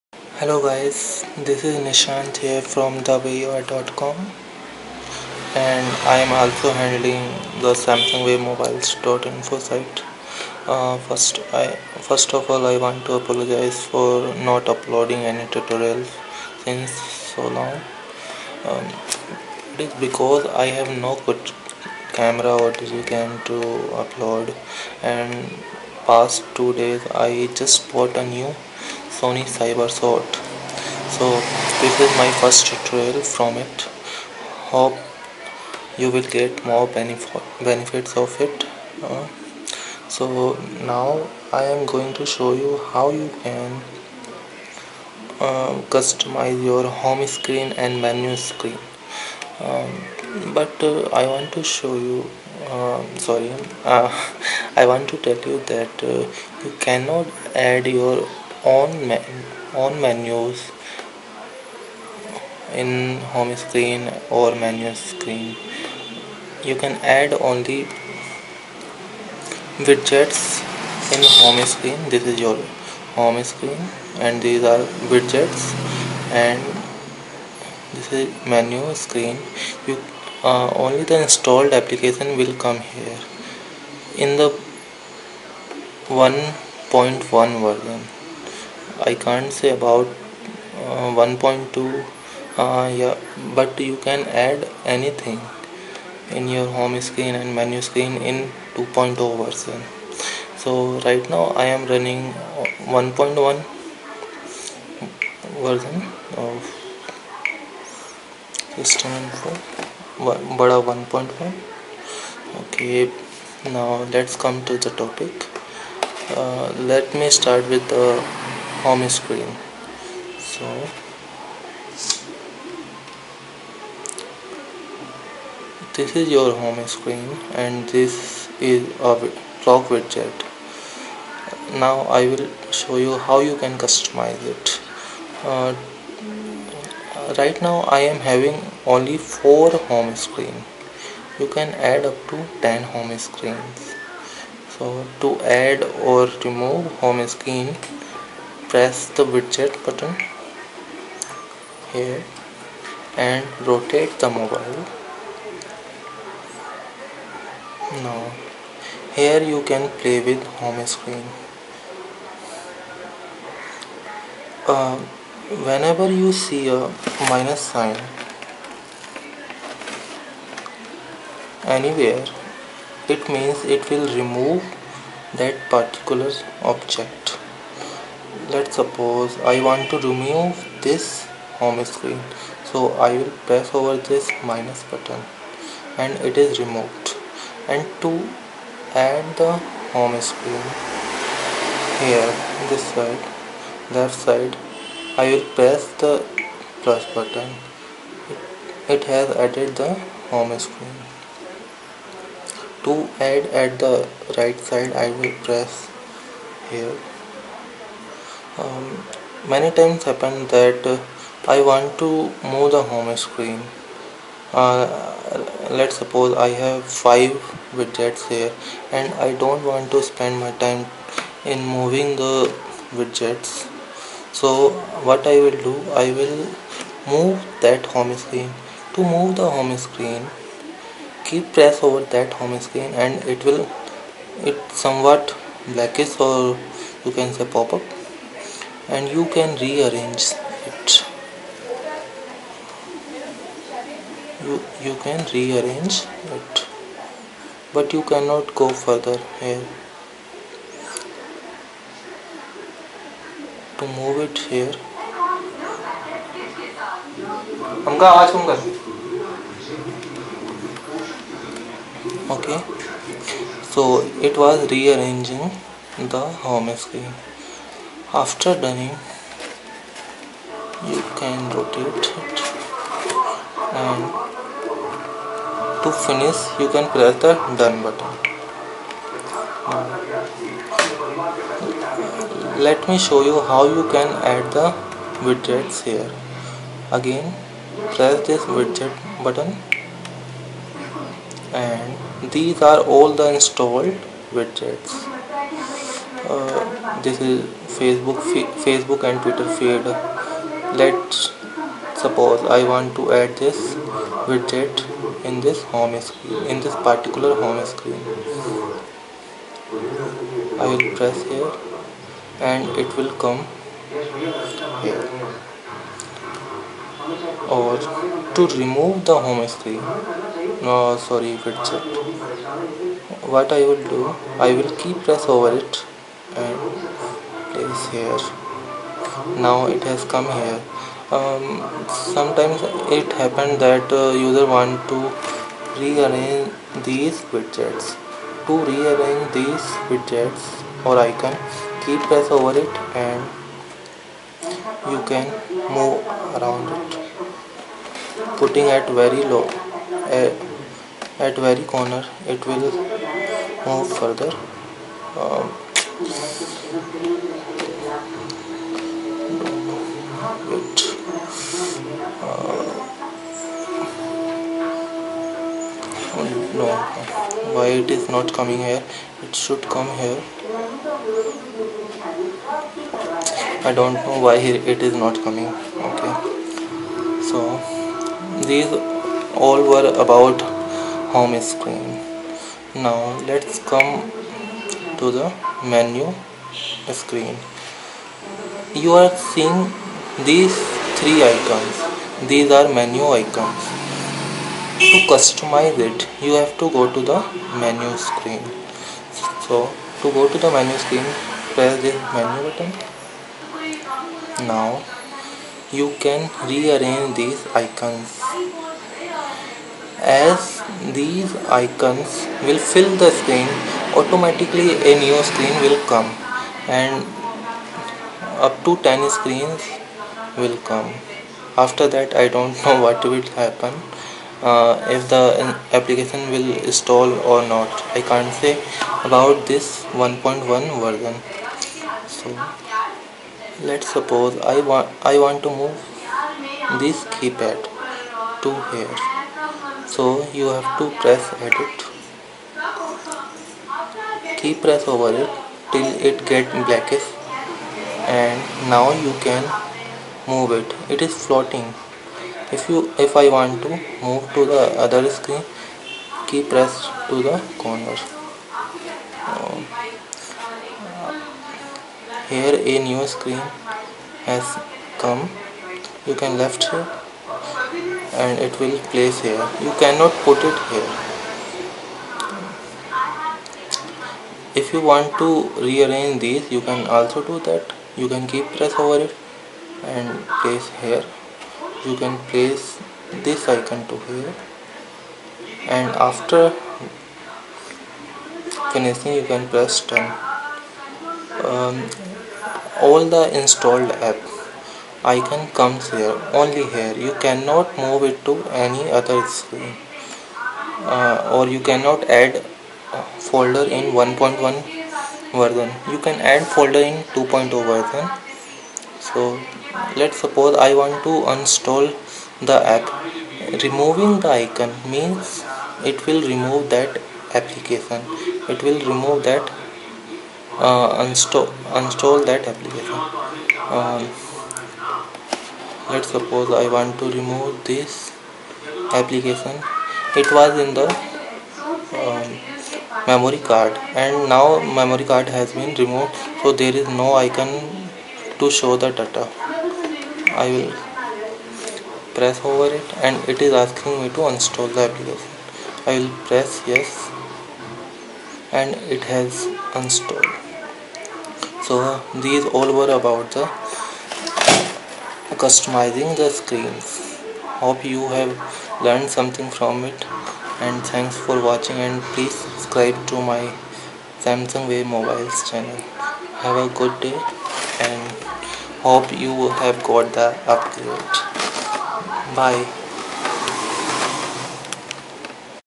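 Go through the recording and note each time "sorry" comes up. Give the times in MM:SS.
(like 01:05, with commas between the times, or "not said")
00:53, 05:21.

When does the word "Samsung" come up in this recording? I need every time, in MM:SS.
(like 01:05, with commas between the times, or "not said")
00:07, 09:24.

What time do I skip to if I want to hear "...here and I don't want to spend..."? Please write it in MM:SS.
03:38.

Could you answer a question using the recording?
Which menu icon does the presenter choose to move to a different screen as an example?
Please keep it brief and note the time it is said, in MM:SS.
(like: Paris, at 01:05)
keypad, at 07:17.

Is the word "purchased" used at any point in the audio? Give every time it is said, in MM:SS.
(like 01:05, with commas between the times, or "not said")
not said.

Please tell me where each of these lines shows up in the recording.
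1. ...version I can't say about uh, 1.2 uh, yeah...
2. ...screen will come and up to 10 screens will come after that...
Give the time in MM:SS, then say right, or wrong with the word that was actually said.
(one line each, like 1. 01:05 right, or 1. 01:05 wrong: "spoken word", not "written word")
1. 01:27 right
2. 06:55 right.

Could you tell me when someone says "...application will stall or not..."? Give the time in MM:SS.
07:05.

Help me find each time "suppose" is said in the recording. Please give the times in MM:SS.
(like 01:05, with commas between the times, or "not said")
02:58, 03:35, 05:02, 07:13, 08:30, 08:46.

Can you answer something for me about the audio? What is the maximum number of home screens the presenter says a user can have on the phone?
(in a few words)
10.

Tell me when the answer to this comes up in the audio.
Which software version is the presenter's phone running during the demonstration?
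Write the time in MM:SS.
01:50.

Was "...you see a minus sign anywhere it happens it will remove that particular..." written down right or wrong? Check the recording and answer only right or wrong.
wrong.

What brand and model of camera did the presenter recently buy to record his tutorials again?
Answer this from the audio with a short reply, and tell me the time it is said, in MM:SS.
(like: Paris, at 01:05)
Sony Cyber-shot, at 00:29.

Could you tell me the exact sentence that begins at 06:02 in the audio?
Uh, oh, no, why it is not coming here?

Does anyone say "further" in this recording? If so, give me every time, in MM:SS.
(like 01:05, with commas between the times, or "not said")
04:08, 05:54.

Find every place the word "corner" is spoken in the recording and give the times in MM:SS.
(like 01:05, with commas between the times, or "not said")
05:51, 07:37.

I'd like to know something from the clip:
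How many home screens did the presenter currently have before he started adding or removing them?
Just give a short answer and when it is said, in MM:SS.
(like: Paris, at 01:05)
4, at 02:18.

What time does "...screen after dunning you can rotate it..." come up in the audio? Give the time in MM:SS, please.
04:26.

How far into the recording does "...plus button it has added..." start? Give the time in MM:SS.
03:16.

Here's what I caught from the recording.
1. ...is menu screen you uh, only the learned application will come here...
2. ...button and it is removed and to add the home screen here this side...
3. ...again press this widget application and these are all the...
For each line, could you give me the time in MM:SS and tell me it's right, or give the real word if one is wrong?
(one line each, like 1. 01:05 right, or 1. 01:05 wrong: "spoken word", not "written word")
1. 01:18 wrong: "installed", not "learned"
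2. 03:04 right
3. 04:46 wrong: "button", not "application".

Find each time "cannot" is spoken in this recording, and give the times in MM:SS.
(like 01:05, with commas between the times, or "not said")
00:56, 04:08, 07:49, 08:17, 08:21.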